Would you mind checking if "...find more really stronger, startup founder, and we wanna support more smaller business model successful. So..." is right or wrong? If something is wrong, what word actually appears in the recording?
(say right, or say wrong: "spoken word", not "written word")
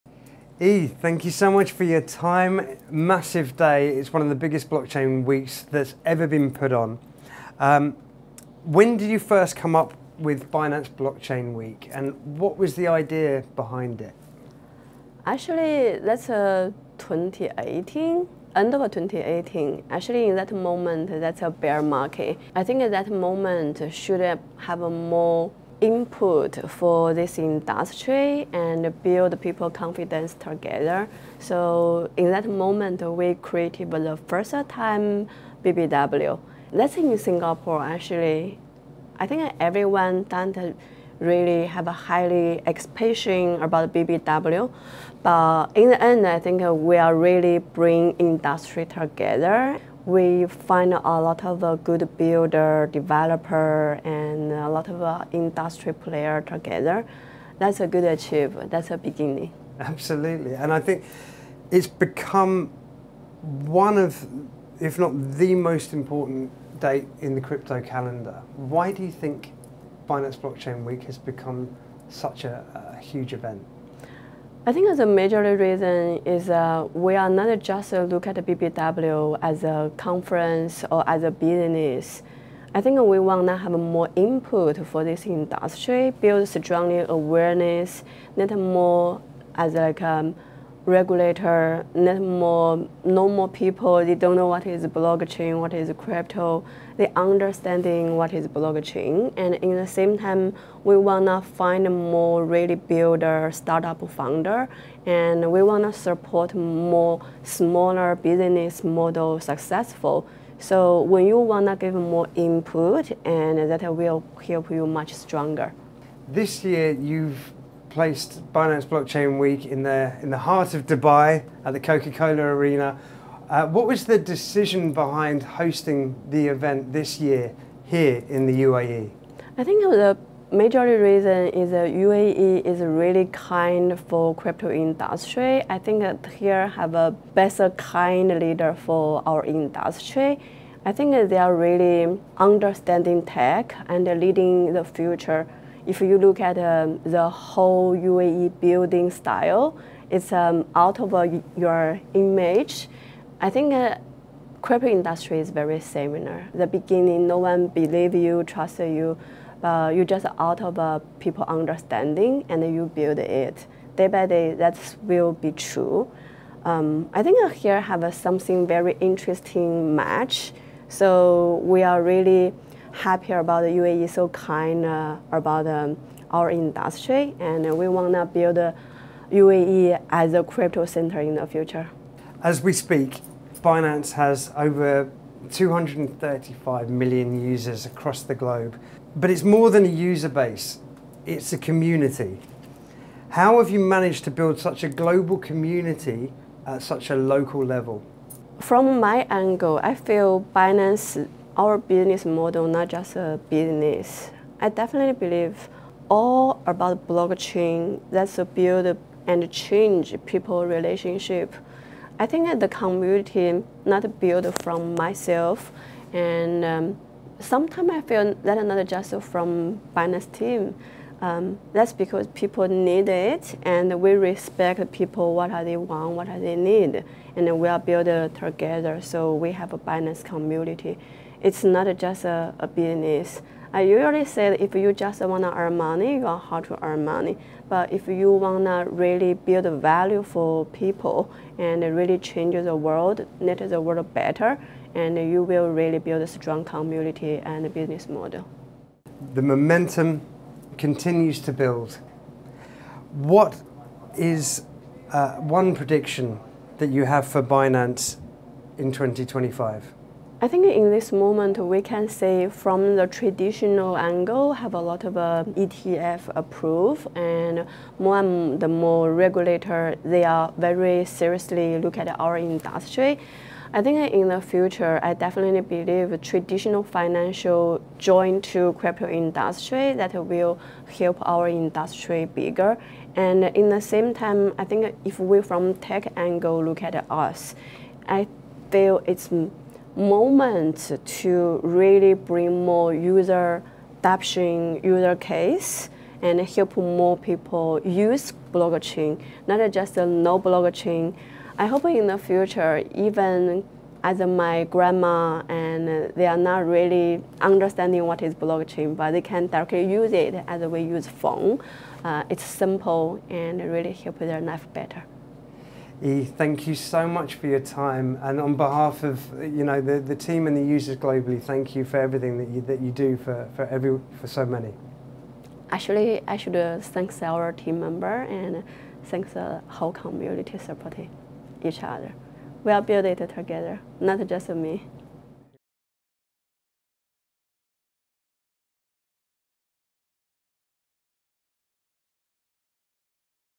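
wrong: "builder", not "stronger".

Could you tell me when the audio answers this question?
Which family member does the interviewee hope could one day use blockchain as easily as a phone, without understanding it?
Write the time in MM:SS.
05:04.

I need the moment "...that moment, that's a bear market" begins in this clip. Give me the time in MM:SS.
00:20.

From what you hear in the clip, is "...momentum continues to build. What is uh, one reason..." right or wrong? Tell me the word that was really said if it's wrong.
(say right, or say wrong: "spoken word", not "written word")
wrong: "prediction", not "reason".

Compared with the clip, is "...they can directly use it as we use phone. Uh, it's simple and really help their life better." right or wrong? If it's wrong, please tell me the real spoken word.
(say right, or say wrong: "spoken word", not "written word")
right.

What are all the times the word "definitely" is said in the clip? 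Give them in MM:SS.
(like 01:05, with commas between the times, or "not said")
03:24, 04:35.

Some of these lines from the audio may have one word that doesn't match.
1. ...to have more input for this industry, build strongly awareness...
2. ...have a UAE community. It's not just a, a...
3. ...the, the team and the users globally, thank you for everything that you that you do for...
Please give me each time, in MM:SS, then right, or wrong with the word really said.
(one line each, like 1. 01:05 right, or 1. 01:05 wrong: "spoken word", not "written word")
1. 01:23 right
2. 03:49 wrong: "Binance", not "UAE"
3. 05:19 right.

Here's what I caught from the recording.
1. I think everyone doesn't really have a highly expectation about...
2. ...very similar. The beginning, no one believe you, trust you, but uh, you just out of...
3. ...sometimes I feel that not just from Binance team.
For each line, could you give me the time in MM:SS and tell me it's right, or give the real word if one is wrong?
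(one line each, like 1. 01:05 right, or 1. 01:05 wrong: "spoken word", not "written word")
1. 00:39 right
2. 02:35 right
3. 03:37 right.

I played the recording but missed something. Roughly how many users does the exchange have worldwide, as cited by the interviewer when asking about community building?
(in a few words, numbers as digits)
235 million.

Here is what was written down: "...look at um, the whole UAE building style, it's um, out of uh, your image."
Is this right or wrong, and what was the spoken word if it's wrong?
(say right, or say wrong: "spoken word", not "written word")
right.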